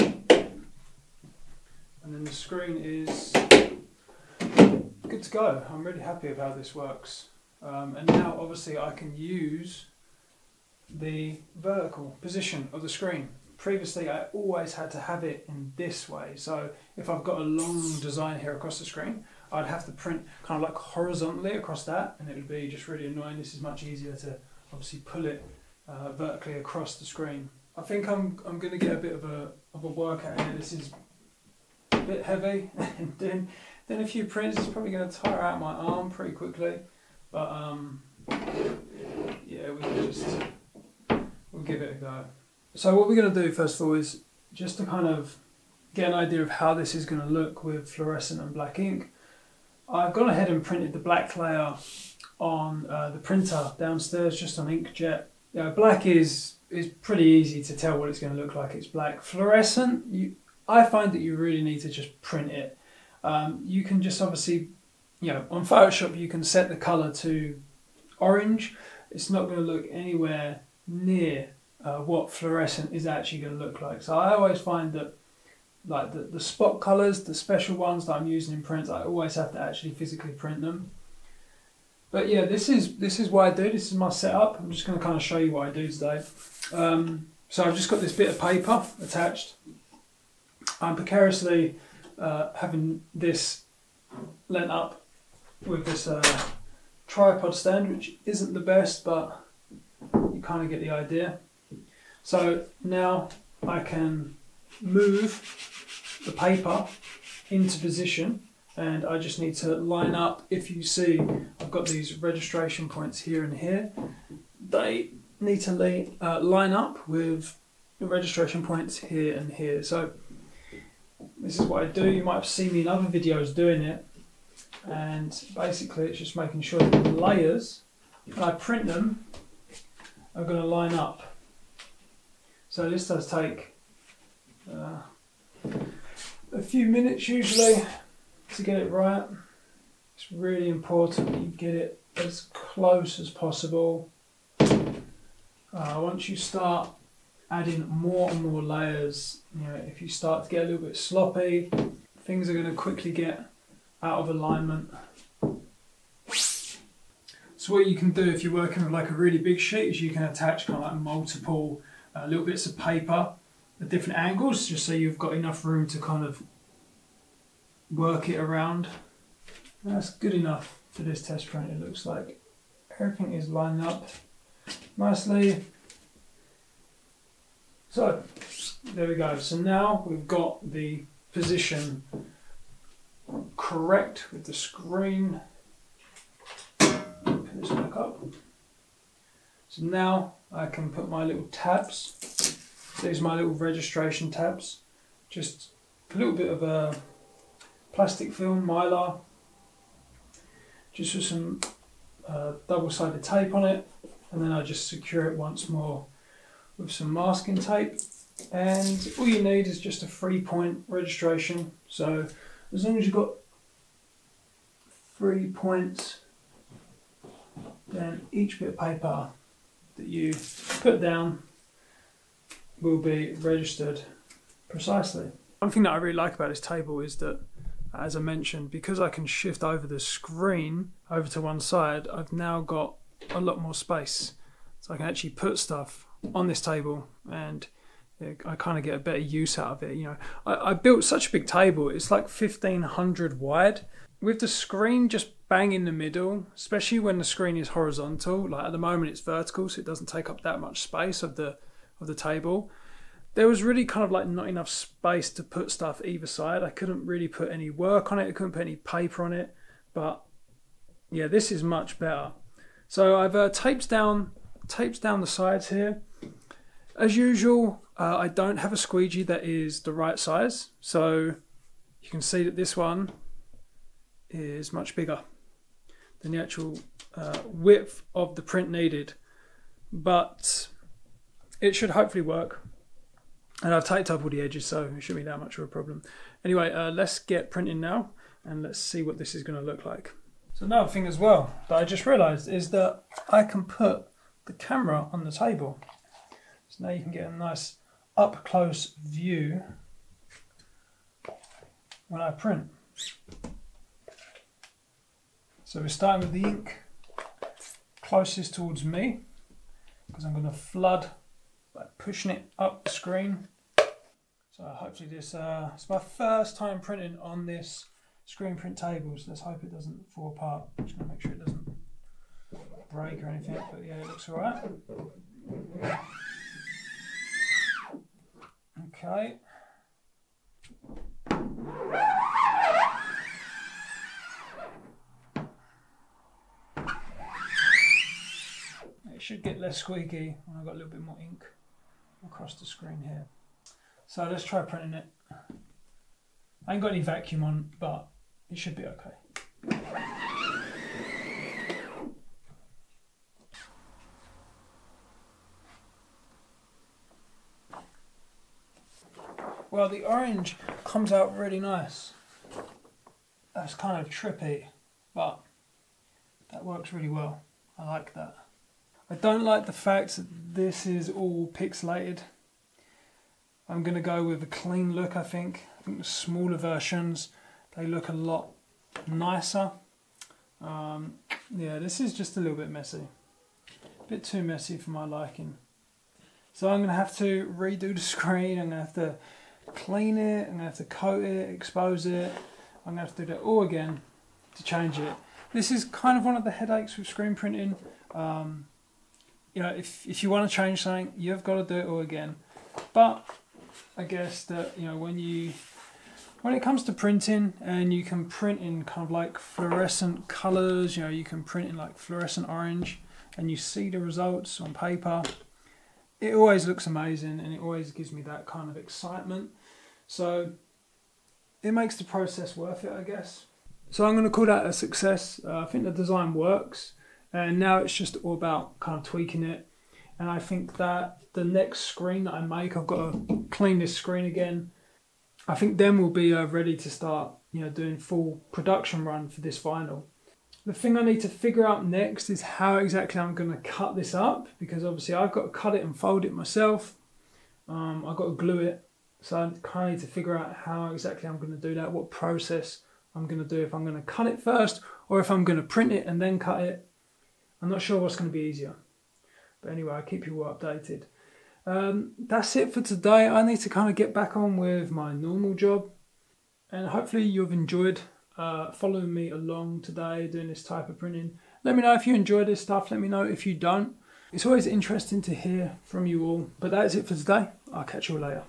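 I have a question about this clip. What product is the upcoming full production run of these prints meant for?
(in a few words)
Vinyl.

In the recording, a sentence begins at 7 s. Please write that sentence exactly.
Um, and now obviously I can use the vertical position of the screen.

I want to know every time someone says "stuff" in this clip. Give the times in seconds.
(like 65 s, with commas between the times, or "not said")
235 s, 255 s, 472 s.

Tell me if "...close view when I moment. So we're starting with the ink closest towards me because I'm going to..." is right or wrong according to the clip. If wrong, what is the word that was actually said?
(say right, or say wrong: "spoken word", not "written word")
wrong: "print", not "moment".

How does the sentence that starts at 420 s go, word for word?
So it makes the process worth it, I guess.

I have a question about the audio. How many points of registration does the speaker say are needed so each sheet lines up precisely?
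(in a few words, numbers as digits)
3.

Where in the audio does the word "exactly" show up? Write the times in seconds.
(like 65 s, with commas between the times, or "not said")
442 s, 450 s.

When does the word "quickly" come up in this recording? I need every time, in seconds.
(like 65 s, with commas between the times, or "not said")
36 s, 152 s.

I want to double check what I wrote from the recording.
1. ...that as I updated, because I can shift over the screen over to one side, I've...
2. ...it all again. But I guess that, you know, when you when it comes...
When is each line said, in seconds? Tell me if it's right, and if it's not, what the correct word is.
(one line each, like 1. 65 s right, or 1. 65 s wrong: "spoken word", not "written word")
1. 227 s wrong: "mentioned", not "updated"
2. 401 s right.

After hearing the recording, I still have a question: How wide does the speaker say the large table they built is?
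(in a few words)
1500.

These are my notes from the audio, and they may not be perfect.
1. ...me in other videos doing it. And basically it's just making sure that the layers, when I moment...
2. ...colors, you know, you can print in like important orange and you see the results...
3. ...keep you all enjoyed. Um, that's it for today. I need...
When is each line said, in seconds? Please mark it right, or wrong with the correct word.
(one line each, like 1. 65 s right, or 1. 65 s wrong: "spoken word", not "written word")
1. 122 s wrong: "print", not "moment"
2. 410 s wrong: "fluorescent", not "important"
3. 460 s wrong: "updated", not "enjoyed".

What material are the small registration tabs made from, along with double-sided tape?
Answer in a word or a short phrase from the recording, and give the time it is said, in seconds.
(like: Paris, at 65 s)
Mylar, at 198 s.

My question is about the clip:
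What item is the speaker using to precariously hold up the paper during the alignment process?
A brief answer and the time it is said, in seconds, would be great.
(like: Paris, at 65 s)
Tripod stand, at 97 s.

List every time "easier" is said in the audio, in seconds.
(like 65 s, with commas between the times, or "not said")
23 s, 458 s.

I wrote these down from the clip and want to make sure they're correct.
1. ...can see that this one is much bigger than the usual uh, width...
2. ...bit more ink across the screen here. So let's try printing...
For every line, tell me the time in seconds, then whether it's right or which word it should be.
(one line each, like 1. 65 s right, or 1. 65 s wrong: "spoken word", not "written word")
1. 272 s wrong: "actual", not "usual"
2. 340 s right.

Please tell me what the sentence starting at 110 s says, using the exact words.
If you see, I've got these registration points here and here.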